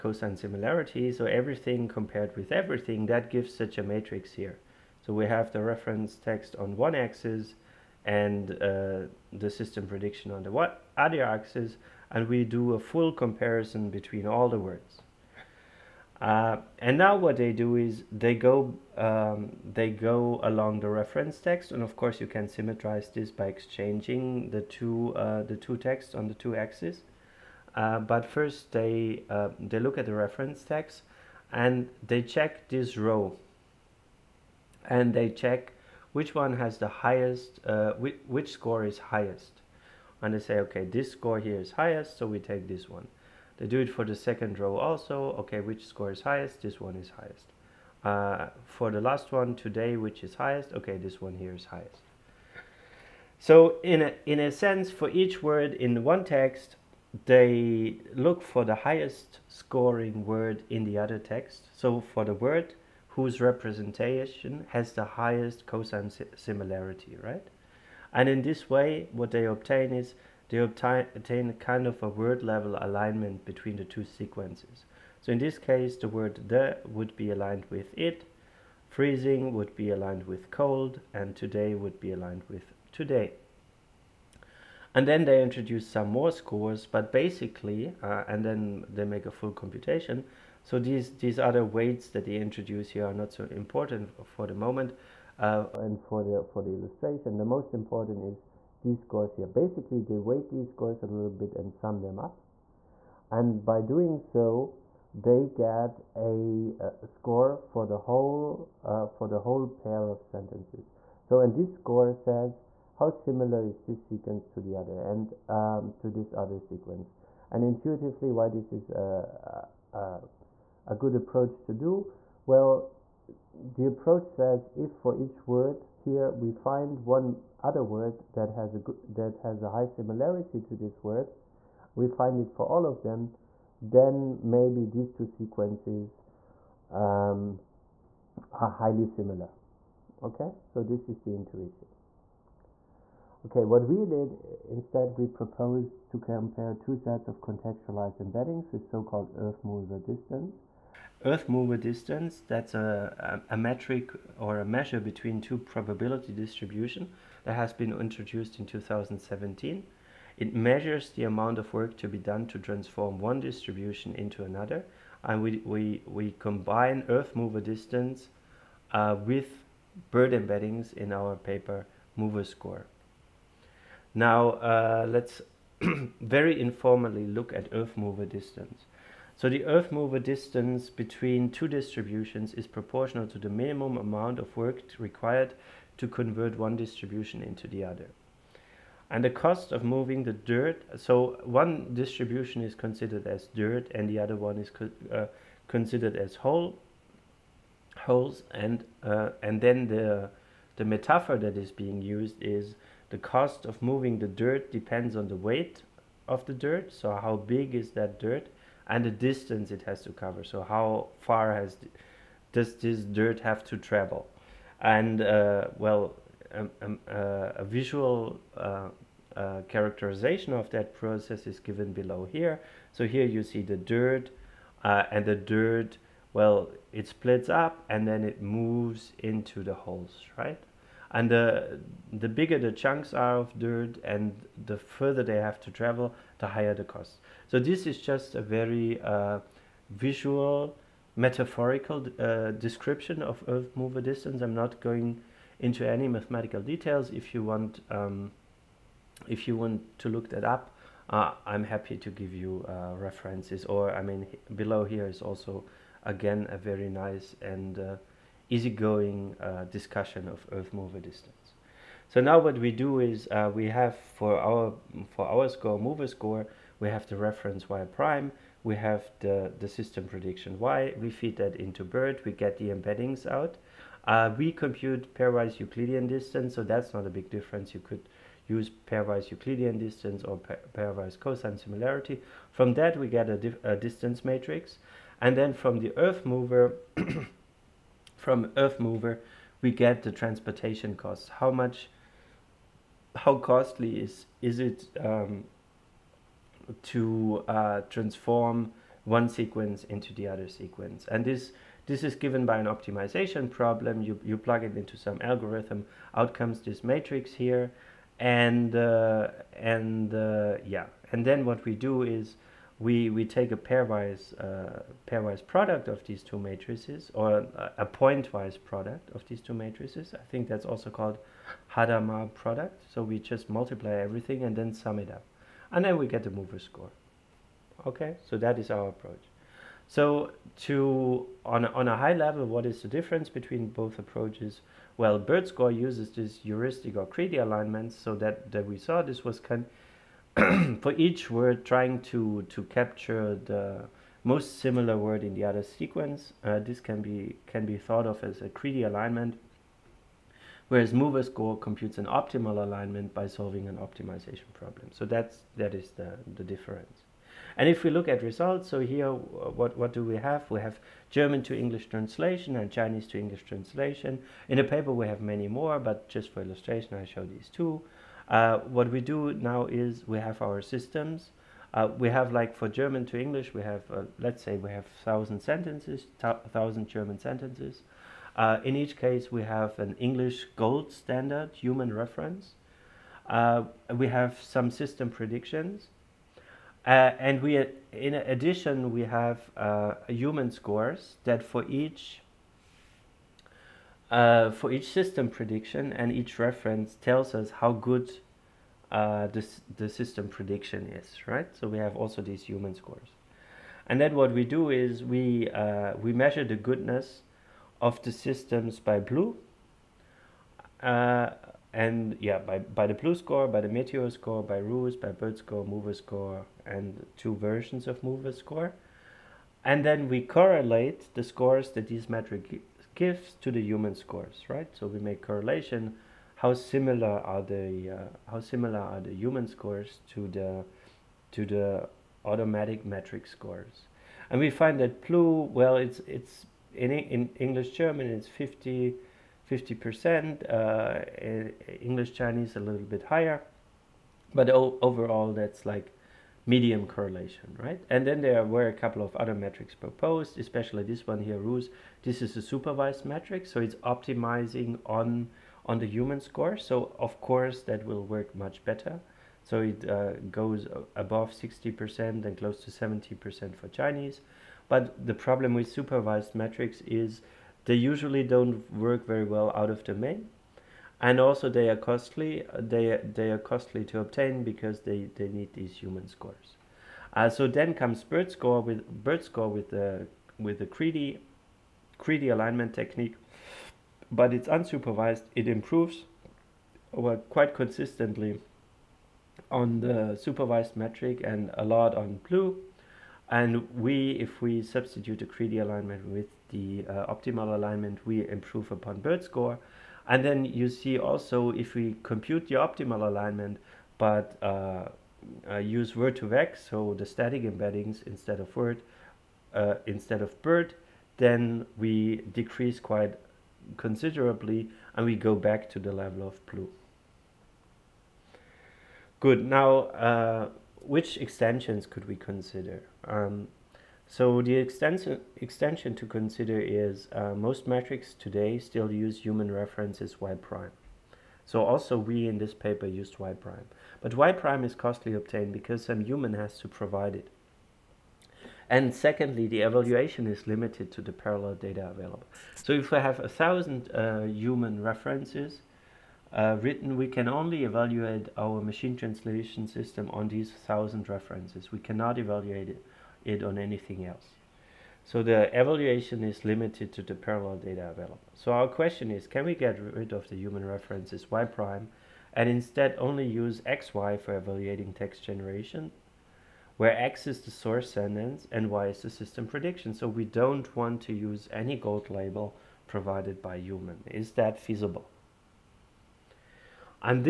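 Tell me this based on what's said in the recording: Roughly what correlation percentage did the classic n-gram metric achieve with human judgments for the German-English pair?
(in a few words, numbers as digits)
50 percent.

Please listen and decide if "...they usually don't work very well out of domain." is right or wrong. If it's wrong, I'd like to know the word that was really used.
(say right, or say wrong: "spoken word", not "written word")
right.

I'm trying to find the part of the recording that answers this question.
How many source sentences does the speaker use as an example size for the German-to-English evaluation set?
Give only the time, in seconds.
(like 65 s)
375 s.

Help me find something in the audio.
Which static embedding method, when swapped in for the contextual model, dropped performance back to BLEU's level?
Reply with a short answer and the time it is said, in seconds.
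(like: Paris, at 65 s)
Word2Vec, at 505 s.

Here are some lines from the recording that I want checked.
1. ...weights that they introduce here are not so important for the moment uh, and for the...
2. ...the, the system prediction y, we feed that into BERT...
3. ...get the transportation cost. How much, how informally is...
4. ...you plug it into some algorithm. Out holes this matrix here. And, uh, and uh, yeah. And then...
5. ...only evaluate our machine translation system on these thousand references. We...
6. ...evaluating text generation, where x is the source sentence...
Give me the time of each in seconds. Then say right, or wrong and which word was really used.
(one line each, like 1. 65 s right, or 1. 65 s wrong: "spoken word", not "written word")
1. 91 s right
2. 269 s right
3. 289 s wrong: "costly", not "informally"
4. 304 s wrong: "comes", not "holes"
5. 547 s right
6. 564 s right.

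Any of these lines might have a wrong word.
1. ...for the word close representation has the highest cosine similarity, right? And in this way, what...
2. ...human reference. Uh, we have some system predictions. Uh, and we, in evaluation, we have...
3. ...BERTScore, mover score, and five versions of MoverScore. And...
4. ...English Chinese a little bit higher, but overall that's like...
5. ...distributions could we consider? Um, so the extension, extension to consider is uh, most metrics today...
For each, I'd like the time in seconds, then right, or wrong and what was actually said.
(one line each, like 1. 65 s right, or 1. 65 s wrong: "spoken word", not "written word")
1. 62 s wrong: "whose", not "close"
2. 381 s wrong: "addition", not "evaluation"
3. 415 s wrong: "two", not "five"
4. 441 s right
5. 521 s wrong: "extensions", not "distributions".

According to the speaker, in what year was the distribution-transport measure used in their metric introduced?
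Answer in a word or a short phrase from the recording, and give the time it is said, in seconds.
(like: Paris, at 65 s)
2017, at 158 s.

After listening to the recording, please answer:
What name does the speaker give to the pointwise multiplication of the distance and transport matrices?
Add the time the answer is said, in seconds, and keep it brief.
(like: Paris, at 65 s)
Hadamard product, at 321 s.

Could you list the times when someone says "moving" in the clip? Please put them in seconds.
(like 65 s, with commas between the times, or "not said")
189 s, 203 s.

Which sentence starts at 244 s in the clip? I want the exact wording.
I'm not going into any mathematical details.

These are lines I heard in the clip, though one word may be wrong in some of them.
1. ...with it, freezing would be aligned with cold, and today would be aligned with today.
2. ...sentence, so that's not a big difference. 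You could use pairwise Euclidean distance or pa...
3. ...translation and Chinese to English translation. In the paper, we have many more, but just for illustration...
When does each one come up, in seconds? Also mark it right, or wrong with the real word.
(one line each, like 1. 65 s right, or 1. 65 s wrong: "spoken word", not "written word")
1. 77 s right
2. 276 s wrong: "distance", not "sentence"
3. 361 s right.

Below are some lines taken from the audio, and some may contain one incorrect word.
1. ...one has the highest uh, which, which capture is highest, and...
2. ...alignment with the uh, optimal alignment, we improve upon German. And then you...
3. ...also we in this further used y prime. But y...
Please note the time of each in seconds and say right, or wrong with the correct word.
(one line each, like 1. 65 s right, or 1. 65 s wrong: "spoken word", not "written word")
1. 36 s wrong: "score", not "capture"
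2. 495 s wrong: "BERTScore", not "German"
3. 531 s wrong: "paper", not "further".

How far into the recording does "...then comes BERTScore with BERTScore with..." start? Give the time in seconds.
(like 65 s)
477 s.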